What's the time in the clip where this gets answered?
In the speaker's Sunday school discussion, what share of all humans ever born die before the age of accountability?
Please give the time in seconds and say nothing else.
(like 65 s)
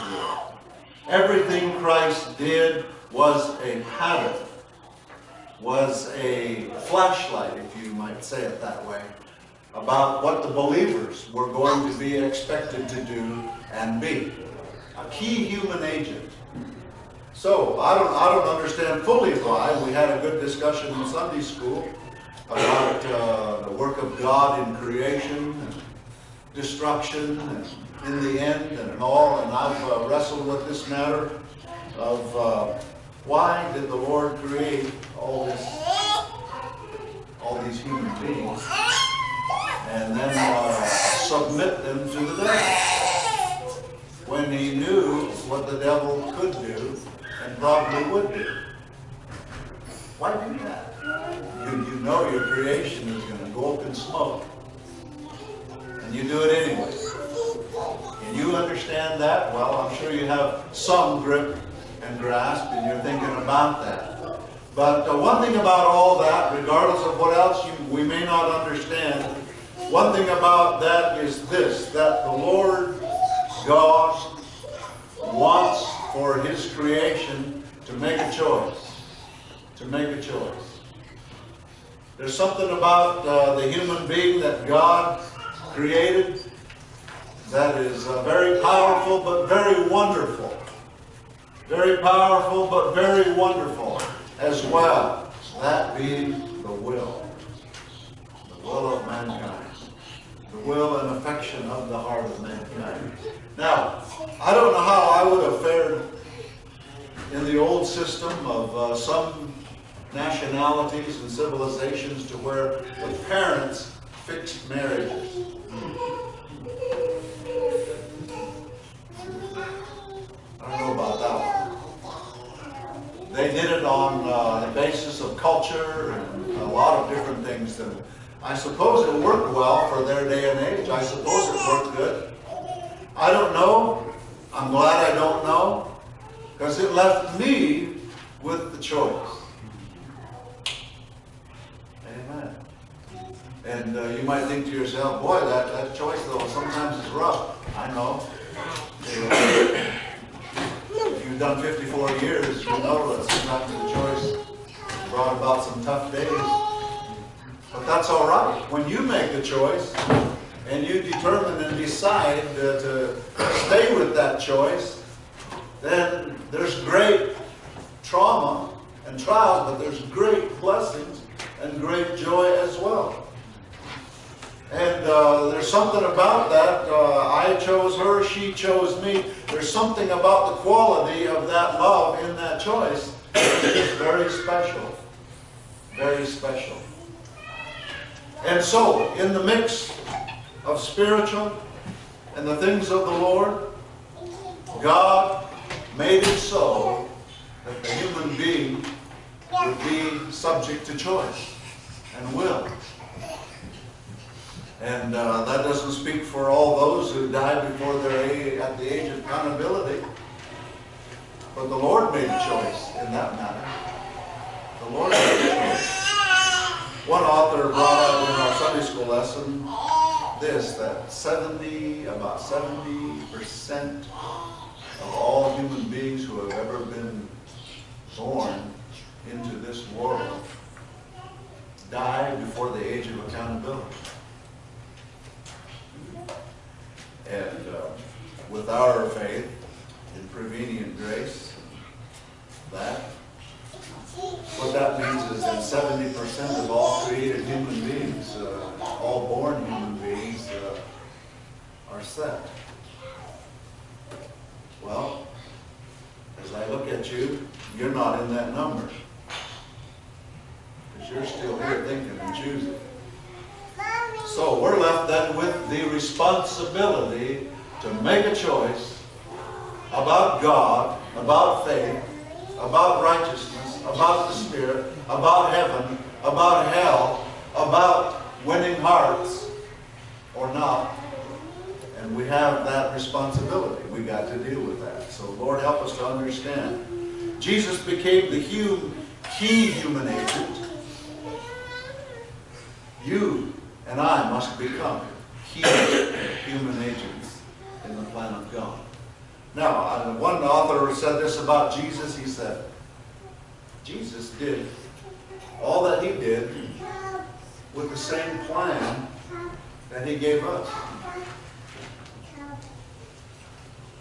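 222 s.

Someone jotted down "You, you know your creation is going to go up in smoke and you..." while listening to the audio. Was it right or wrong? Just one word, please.
right.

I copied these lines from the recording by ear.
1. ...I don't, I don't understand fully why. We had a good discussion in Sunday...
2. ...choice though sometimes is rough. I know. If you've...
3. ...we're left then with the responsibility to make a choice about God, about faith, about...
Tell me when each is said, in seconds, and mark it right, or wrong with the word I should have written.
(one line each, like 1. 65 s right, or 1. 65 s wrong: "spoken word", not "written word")
1. 17 s right
2. 145 s right
3. 264 s right.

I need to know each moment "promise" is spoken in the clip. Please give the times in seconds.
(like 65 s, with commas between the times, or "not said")
not said.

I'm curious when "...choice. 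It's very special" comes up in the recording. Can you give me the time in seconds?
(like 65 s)
182 s.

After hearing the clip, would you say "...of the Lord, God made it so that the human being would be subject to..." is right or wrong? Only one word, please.
right.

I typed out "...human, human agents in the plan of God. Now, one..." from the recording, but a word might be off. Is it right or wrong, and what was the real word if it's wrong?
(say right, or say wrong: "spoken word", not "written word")
right.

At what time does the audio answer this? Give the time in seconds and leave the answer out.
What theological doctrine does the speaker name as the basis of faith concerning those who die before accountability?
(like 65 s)
240 s.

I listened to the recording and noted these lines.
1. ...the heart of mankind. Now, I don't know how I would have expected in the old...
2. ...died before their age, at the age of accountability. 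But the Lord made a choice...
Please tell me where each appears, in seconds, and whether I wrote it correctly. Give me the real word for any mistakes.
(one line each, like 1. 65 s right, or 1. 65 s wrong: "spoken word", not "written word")
1. 101 s wrong: "fared", not "expected"
2. 207 s right.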